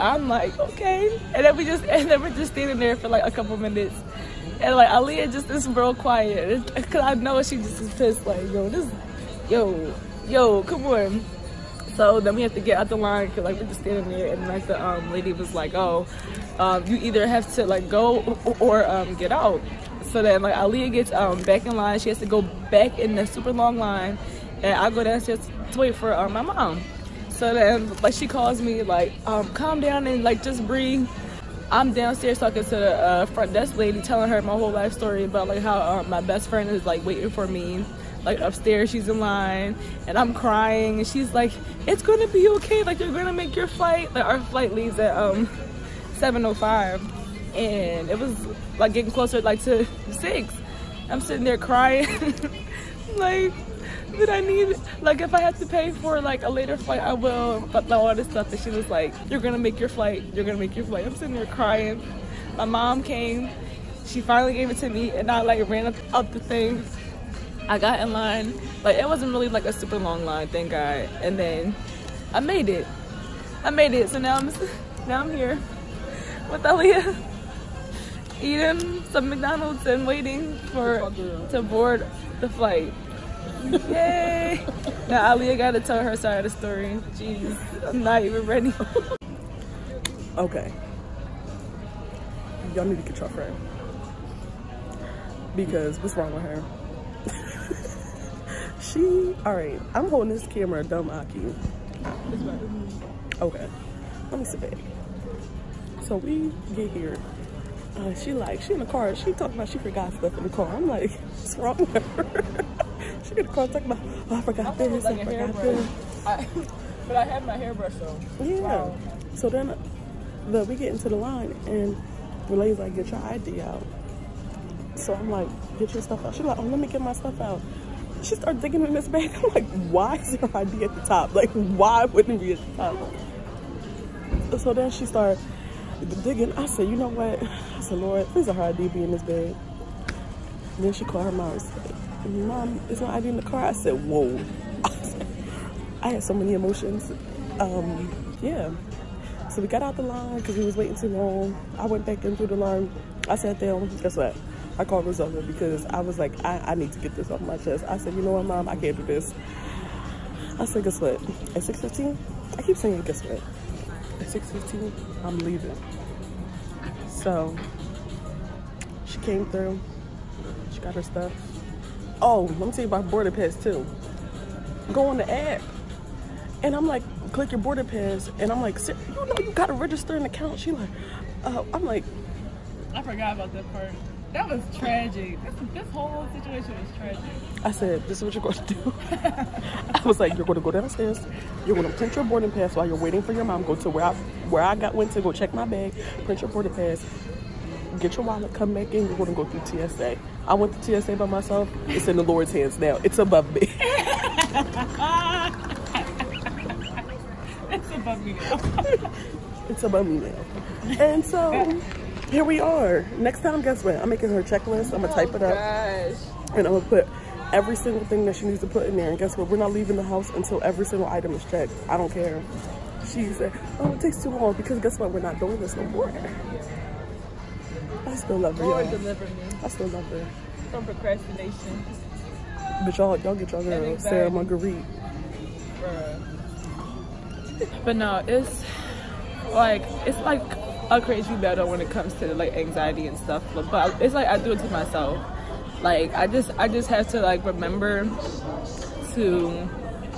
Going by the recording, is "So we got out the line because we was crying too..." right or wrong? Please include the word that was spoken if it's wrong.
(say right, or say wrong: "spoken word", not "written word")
wrong: "waiting", not "crying".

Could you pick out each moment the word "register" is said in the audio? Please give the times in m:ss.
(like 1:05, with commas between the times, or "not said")
2:59.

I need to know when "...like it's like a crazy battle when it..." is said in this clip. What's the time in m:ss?
3:59.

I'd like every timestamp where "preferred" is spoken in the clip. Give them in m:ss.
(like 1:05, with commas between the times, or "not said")
not said.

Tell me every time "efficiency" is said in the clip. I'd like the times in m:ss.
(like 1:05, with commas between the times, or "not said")
not said.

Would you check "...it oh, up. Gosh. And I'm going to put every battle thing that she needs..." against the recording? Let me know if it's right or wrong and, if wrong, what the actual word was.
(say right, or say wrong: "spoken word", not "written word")
wrong: "single", not "battle".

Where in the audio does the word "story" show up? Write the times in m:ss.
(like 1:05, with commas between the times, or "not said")
0:34, 1:26.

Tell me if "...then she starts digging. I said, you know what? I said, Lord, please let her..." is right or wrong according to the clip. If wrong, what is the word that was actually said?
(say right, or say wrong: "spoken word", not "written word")
right.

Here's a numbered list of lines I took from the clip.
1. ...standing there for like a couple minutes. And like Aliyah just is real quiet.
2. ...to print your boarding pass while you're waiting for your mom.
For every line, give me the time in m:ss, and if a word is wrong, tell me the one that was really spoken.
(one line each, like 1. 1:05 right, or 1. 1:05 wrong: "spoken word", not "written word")
1. 0:02 right
2. 3:11 right.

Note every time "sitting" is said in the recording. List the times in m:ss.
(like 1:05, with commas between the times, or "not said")
0:51, 1:01.